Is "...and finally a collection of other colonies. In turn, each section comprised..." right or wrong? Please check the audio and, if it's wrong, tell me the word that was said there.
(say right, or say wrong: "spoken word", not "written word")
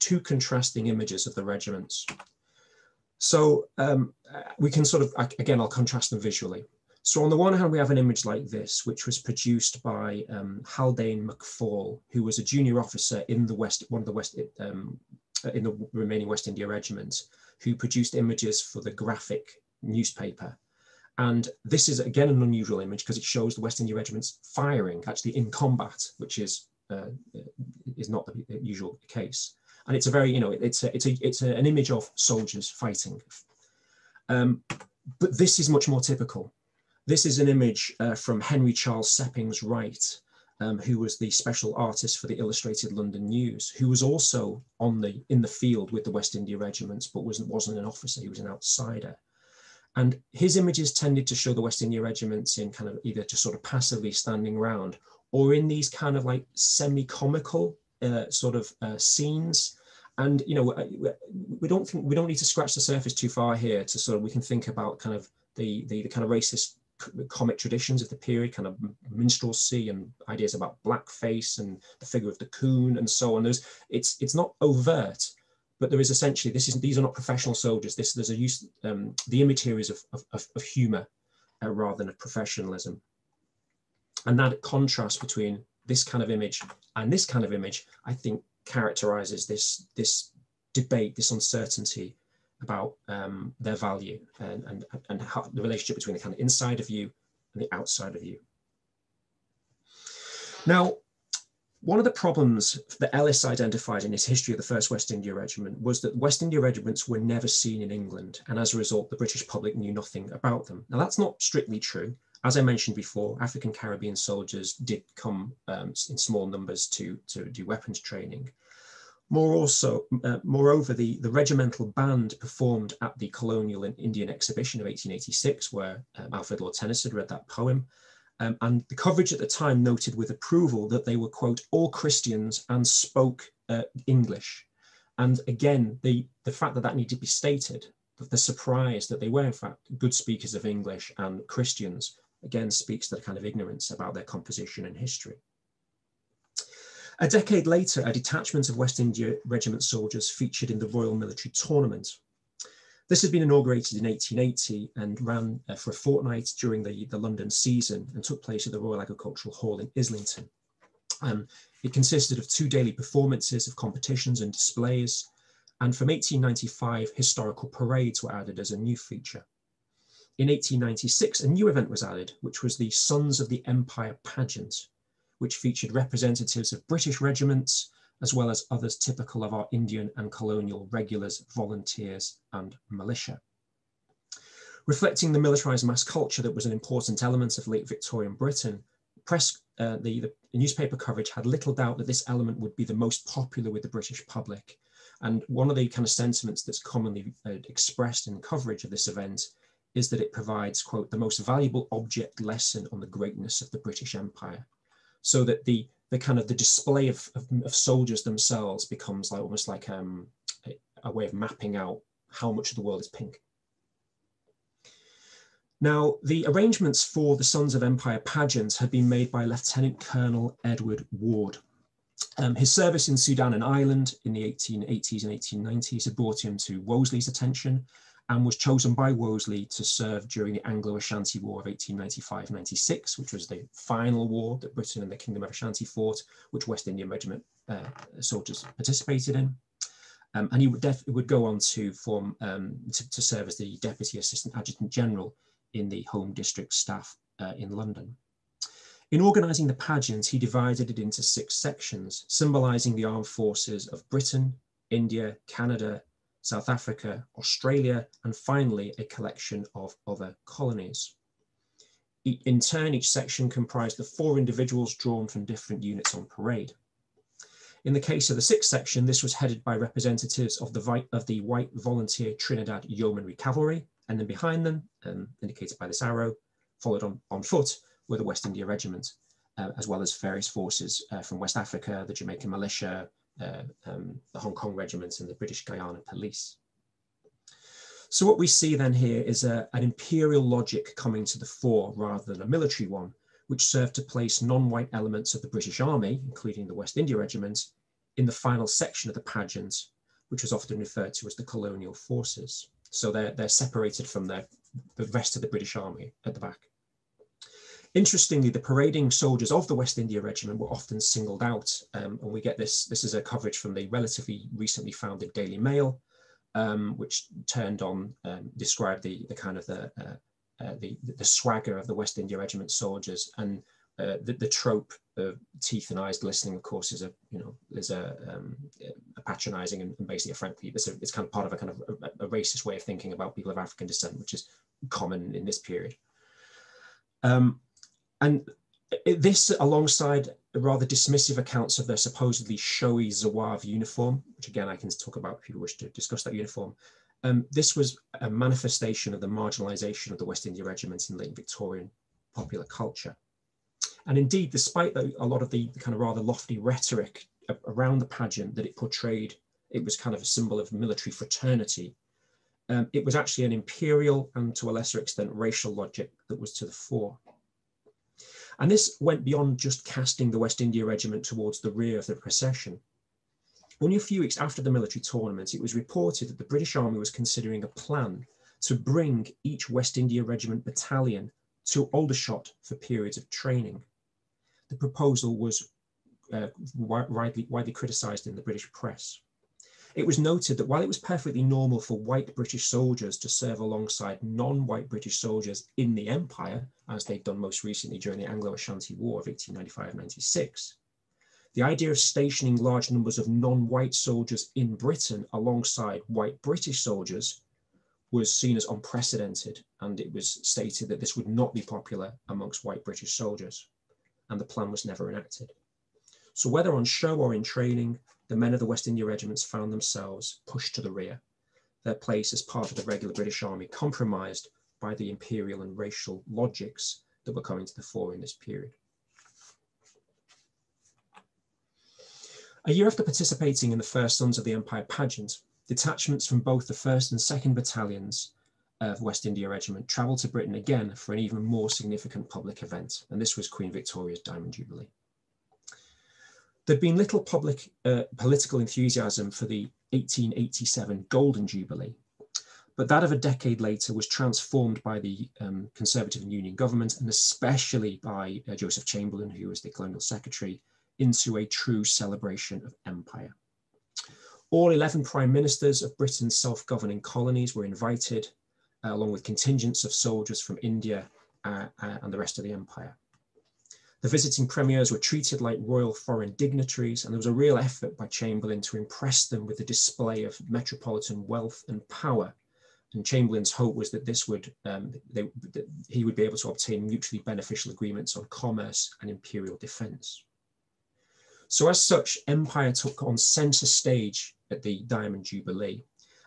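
right.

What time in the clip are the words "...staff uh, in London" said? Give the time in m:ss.
4:06.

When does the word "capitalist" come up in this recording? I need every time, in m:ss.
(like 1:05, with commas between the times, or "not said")
not said.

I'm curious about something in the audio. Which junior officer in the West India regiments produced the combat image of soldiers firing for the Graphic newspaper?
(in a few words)
Haldane Macfall.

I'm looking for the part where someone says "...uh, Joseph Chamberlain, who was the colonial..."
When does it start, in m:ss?
7:38.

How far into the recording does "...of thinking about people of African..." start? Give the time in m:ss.
5:32.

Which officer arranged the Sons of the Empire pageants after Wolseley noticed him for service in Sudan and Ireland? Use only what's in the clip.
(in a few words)
Edward Ward.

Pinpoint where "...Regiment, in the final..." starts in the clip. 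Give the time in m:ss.
4:57.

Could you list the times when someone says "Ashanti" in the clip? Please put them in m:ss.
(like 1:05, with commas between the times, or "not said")
3:50, 3:55, 6:38.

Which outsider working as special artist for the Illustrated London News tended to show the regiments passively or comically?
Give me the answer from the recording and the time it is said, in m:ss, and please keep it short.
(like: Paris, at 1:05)
Henry Charles Seppings Wright, at 0:38.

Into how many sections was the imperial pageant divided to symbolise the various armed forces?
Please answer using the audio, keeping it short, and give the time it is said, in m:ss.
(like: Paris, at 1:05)
6, at 4:11.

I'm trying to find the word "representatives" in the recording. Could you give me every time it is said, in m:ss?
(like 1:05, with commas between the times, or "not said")
2:55, 4:29.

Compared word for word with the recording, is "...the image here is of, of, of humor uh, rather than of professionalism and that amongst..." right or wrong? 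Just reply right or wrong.
wrong.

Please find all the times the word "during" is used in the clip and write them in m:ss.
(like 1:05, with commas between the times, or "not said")
2:36, 3:50, 6:37.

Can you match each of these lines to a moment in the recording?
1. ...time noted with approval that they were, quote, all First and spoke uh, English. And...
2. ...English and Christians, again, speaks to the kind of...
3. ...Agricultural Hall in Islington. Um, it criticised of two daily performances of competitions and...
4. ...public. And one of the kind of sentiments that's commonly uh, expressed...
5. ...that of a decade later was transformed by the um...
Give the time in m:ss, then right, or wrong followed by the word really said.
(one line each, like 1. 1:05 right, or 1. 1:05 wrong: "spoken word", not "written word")
1. 2:09 wrong: "Christians", not "First"
2. 2:20 right
3. 2:39 wrong: "consisted", not "criticised"
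4. 3:14 right
5. 7:32 right.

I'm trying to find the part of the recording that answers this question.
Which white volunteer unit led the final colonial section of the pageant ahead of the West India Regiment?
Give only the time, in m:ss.
4:32.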